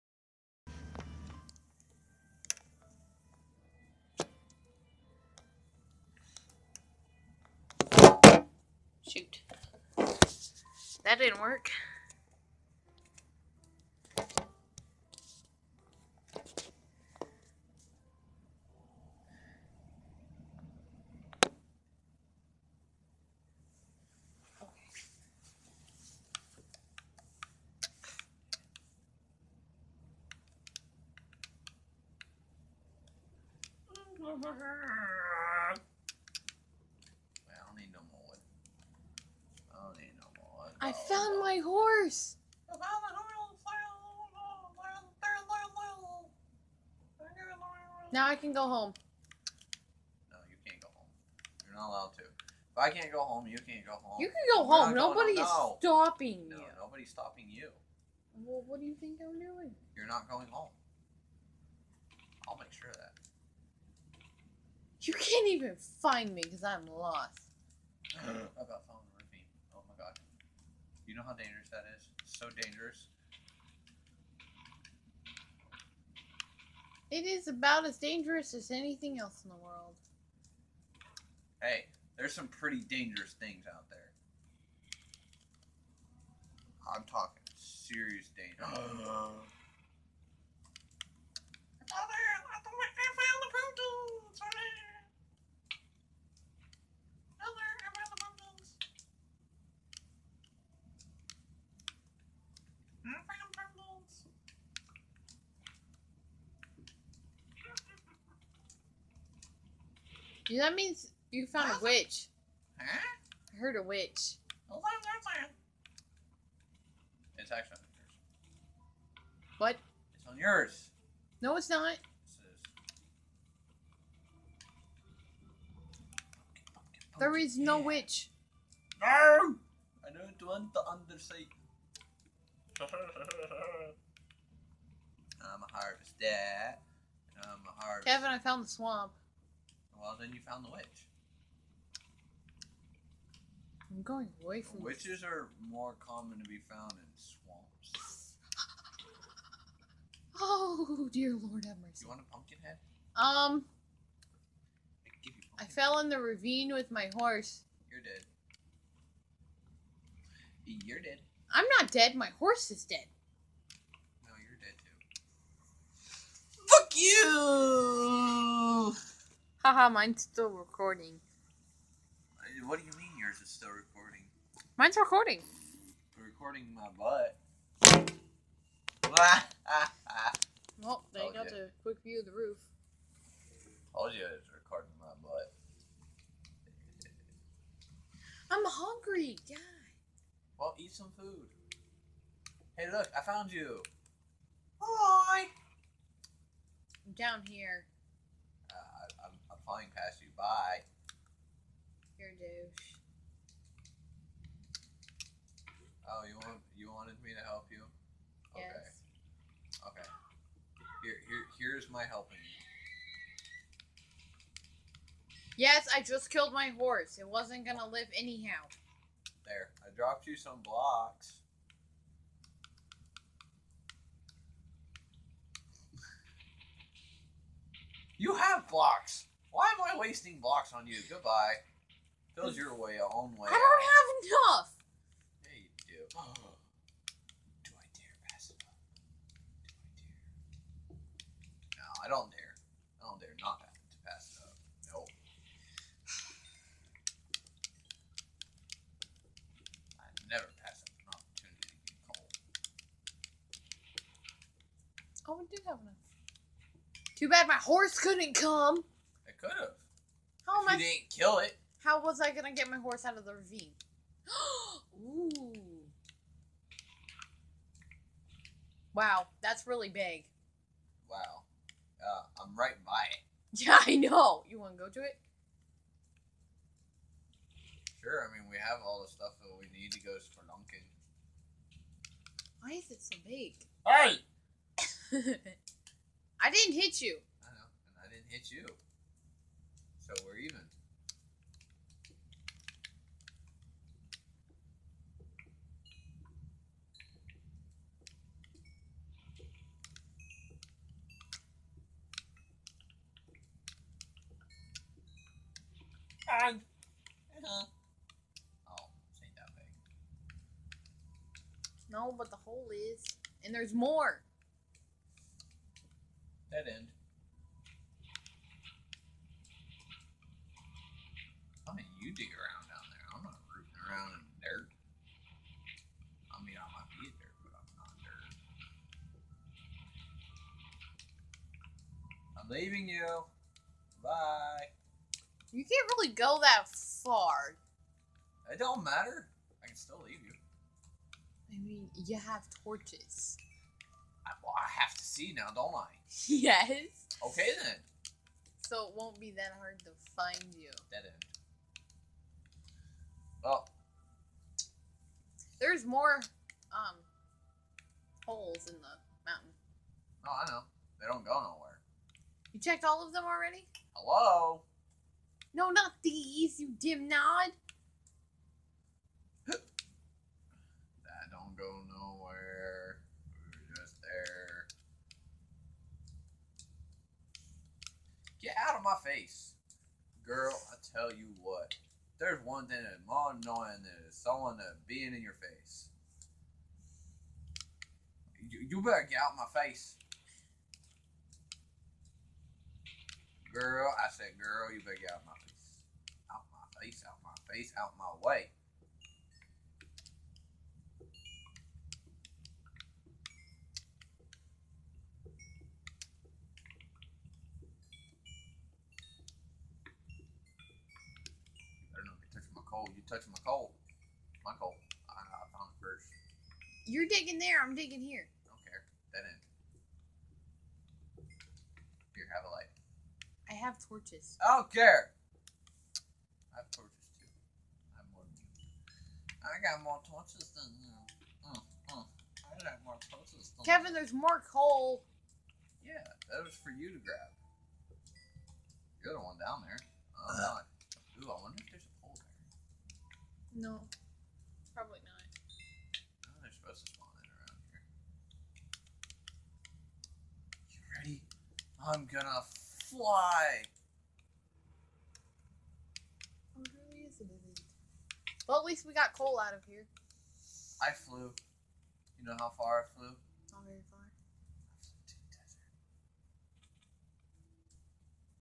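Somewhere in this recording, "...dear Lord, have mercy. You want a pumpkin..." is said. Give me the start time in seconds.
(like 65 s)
151 s.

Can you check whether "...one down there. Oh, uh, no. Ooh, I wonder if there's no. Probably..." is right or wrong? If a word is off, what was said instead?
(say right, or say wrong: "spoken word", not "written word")
right.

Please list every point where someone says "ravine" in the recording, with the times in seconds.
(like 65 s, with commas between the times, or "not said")
156 s, 263 s.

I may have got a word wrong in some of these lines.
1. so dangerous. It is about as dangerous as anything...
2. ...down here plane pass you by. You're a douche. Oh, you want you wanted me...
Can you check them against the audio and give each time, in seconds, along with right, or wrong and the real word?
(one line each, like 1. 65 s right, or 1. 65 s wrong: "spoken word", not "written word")
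1. 72 s right
2. 197 s right.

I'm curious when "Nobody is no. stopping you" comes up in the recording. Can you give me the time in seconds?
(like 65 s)
54 s.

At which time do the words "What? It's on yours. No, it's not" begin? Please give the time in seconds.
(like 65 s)
119 s.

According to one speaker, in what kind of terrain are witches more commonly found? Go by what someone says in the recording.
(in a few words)
swamps.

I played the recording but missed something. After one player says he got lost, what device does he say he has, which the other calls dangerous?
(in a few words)
phone.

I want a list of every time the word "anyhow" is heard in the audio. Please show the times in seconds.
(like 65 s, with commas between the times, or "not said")
218 s.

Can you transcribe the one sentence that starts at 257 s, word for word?
Too bad my horse couldn't come.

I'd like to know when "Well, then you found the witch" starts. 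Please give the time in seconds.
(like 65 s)
140 s.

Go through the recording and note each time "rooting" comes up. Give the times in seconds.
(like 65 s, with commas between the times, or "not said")
323 s.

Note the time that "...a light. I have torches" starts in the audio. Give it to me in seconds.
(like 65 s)
422 s.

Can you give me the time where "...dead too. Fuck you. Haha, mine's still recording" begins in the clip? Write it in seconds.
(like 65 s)
164 s.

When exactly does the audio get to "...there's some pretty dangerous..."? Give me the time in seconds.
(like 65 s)
82 s.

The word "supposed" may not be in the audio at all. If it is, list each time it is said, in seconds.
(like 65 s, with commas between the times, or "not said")
446 s.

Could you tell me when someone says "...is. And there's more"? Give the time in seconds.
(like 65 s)
312 s.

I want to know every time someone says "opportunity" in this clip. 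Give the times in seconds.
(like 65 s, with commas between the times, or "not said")
251 s.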